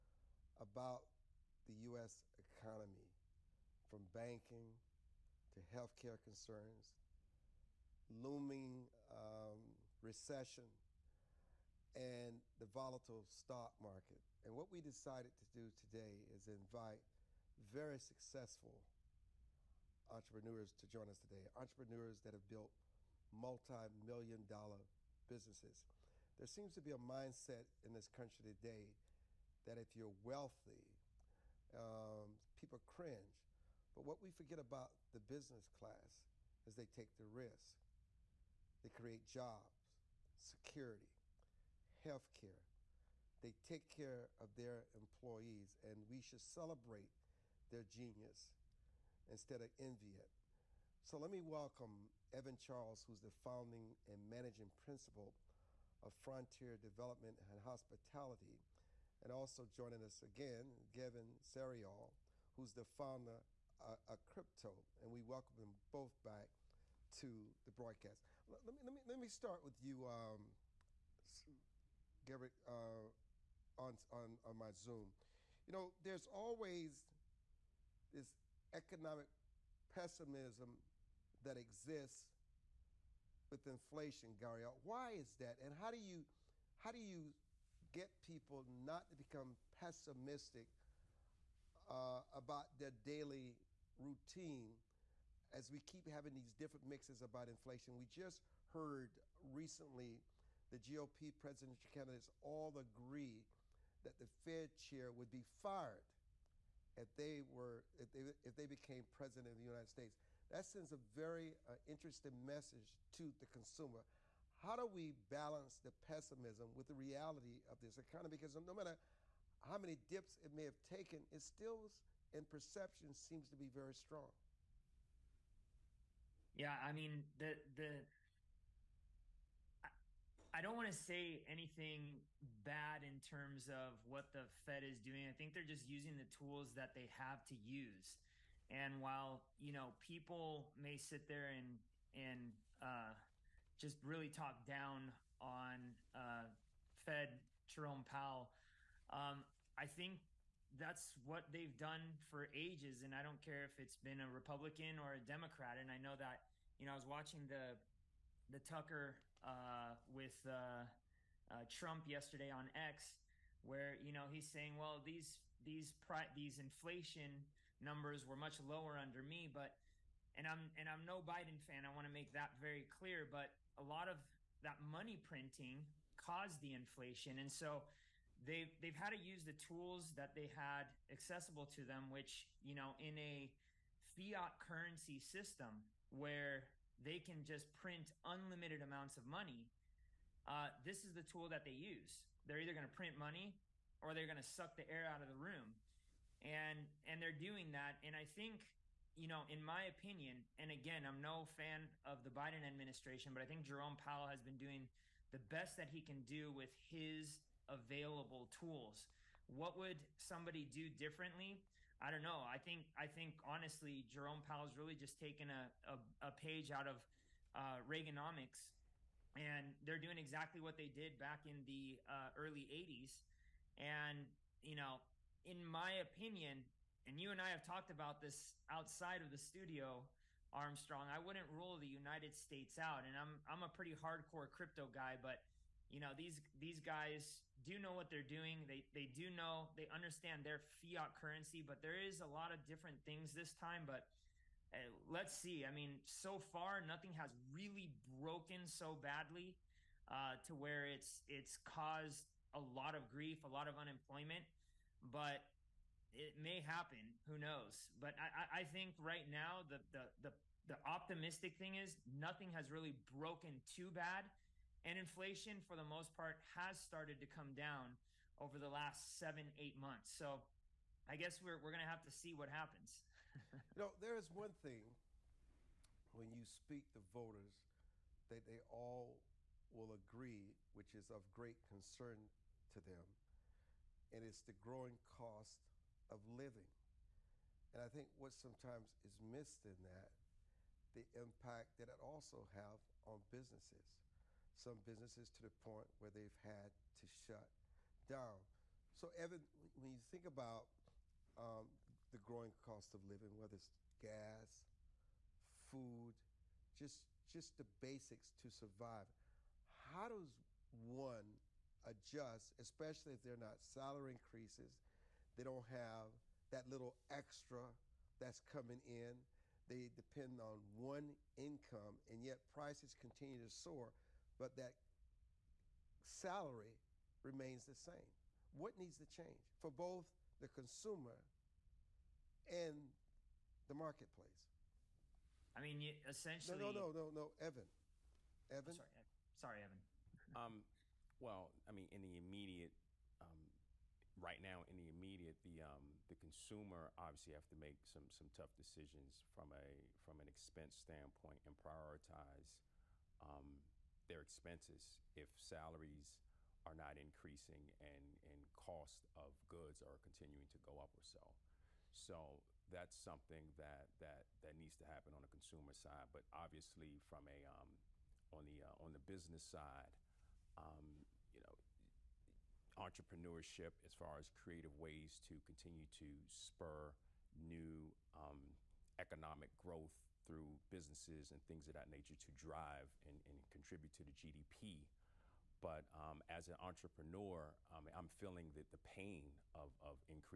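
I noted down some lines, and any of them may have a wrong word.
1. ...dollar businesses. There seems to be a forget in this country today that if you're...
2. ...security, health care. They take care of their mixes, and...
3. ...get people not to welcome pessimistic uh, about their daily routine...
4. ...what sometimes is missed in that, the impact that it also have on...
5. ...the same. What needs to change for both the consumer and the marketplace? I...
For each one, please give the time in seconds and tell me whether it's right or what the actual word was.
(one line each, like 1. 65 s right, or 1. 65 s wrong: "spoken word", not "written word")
1. 24 s wrong: "mindset", not "forget"
2. 40 s wrong: "employees", not "mixes"
3. 87 s wrong: "become", not "welcome"
4. 288 s right
5. 327 s right.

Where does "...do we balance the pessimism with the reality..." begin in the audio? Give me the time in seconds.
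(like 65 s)
114 s.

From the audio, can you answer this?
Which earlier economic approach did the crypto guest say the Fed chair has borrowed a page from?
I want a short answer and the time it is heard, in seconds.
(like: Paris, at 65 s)
Reaganomics, at 217 s.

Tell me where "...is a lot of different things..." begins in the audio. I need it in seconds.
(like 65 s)
242 s.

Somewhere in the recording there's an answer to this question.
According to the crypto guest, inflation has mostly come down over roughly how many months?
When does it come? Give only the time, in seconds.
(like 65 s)
269 s.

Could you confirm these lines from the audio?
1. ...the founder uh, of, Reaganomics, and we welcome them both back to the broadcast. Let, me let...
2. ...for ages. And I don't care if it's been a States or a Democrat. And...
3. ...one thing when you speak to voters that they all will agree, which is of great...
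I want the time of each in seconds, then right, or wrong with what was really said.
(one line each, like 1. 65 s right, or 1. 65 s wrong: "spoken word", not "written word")
1. 62 s wrong: "Crypto", not "Reaganomics"
2. 152 s wrong: "Republican", not "States"
3. 274 s right.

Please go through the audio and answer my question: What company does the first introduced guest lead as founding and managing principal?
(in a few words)
Frontier Development and Hospitality.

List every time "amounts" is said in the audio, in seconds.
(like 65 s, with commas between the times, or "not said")
188 s.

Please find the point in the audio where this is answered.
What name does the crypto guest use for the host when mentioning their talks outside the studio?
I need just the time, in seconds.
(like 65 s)
230 s.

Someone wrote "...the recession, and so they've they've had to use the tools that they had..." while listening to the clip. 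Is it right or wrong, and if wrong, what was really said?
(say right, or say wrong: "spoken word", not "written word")
wrong: "inflation", not "recession".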